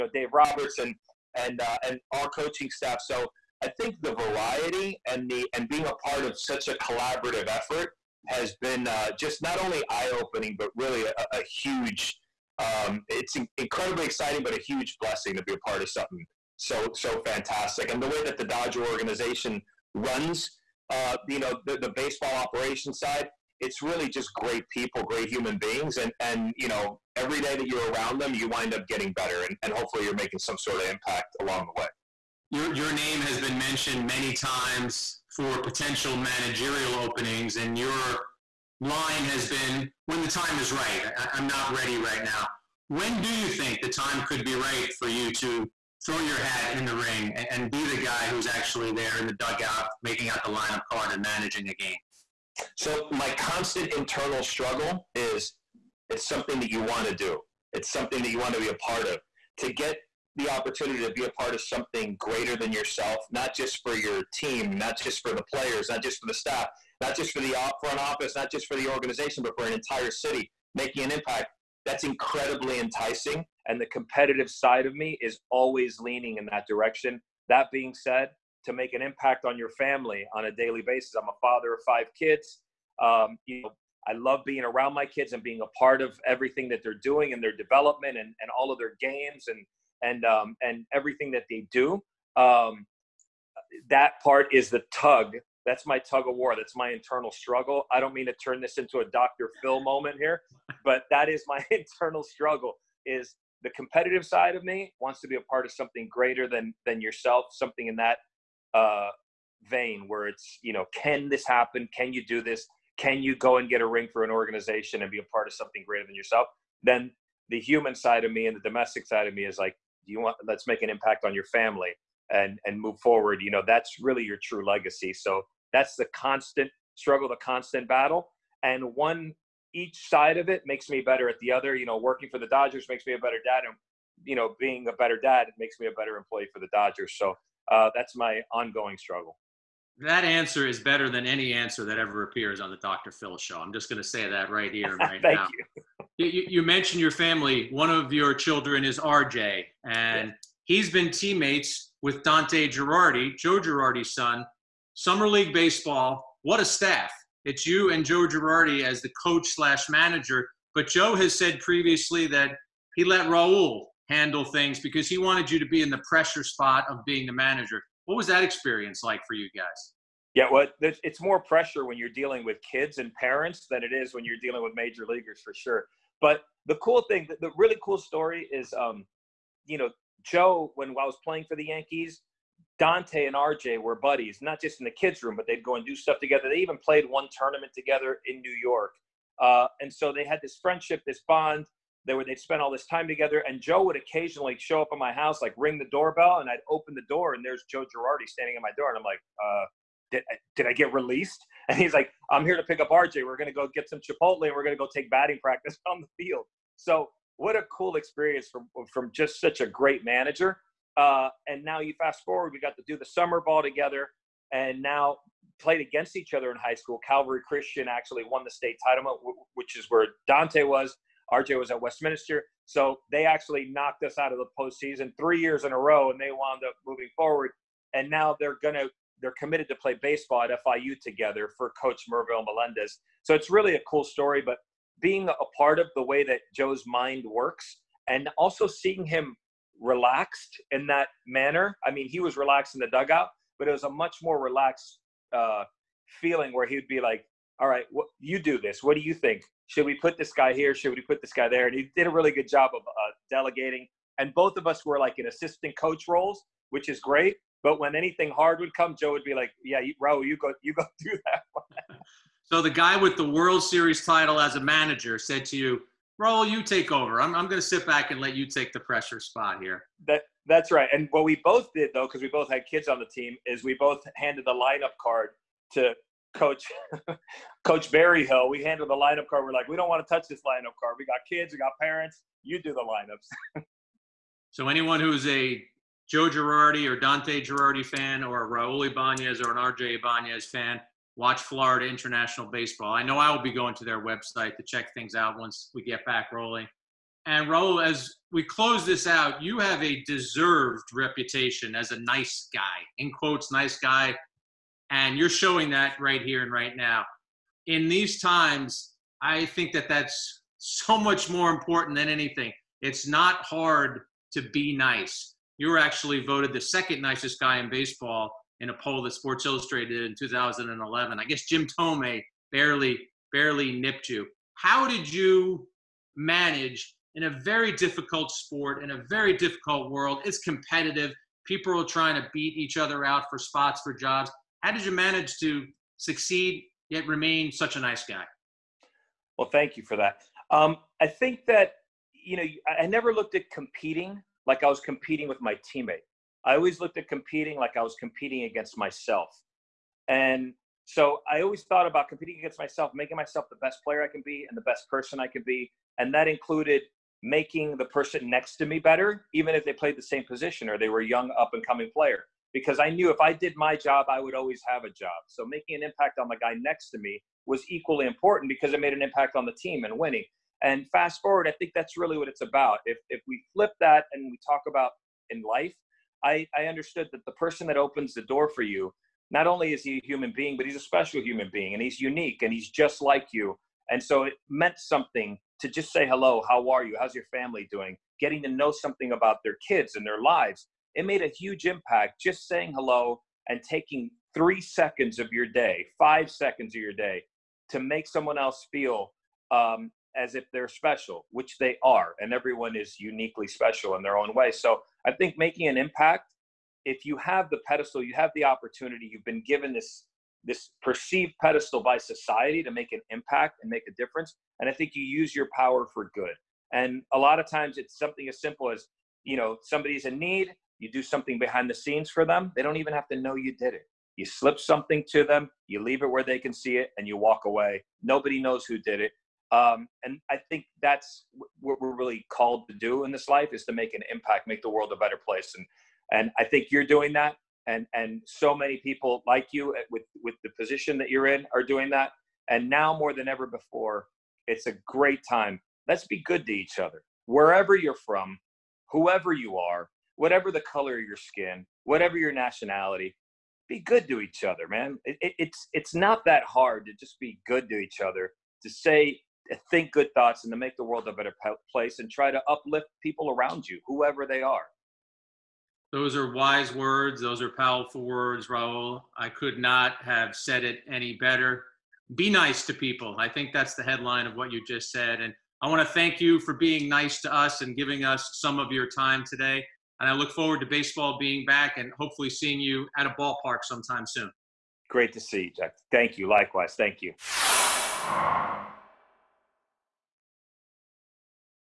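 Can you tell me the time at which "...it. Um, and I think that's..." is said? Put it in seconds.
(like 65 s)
428 s.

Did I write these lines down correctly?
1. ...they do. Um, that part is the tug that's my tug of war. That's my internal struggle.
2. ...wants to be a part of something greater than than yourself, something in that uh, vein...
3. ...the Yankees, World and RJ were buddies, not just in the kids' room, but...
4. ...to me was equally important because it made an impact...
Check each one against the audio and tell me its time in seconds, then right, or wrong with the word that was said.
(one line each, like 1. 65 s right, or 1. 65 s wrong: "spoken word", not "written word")
1. 91 s right
2. 104 s right
3. 181 s wrong: "Dante", not "World"
4. 366 s right.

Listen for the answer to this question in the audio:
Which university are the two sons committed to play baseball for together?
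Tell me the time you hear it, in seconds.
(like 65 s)
230 s.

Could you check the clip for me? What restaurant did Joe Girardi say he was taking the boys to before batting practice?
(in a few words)
Chipotle.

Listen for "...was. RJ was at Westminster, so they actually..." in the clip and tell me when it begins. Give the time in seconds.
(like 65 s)
220 s.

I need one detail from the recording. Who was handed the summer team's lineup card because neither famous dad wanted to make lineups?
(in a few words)
Coach Barry Hill.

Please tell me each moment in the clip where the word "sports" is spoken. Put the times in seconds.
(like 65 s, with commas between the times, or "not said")
319 s, 328 s.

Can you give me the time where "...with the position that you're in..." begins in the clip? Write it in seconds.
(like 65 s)
440 s.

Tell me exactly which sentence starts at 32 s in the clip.
Your your name has been mentioned many times for potential managerial openings, and your line has been when the time is right.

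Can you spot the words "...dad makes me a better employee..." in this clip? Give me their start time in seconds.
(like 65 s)
135 s.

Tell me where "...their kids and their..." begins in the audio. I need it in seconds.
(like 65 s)
389 s.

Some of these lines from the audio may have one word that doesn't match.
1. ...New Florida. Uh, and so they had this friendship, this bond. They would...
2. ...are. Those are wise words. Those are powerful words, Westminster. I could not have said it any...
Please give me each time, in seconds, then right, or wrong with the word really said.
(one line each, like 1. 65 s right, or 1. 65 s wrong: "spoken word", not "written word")
1. 188 s wrong: "York", not "Florida"
2. 464 s wrong: "Raul", not "Westminster".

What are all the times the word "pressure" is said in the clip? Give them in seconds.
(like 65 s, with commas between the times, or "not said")
166 s, 171 s, 268 s.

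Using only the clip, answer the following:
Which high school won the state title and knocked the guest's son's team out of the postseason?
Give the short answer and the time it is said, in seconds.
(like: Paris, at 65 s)
Calvary Christian, at 217 s.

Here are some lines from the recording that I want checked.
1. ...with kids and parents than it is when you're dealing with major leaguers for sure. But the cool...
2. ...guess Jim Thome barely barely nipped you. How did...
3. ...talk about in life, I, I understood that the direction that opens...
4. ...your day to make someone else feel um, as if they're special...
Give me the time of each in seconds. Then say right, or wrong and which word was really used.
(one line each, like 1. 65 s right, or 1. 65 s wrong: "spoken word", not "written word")
1. 172 s right
2. 321 s right
3. 374 s wrong: "person", not "direction"
4. 396 s right.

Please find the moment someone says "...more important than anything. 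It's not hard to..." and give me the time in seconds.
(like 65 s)
311 s.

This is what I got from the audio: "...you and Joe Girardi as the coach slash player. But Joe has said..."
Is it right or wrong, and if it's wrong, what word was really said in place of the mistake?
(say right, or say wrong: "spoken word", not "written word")
wrong: "manager", not "player".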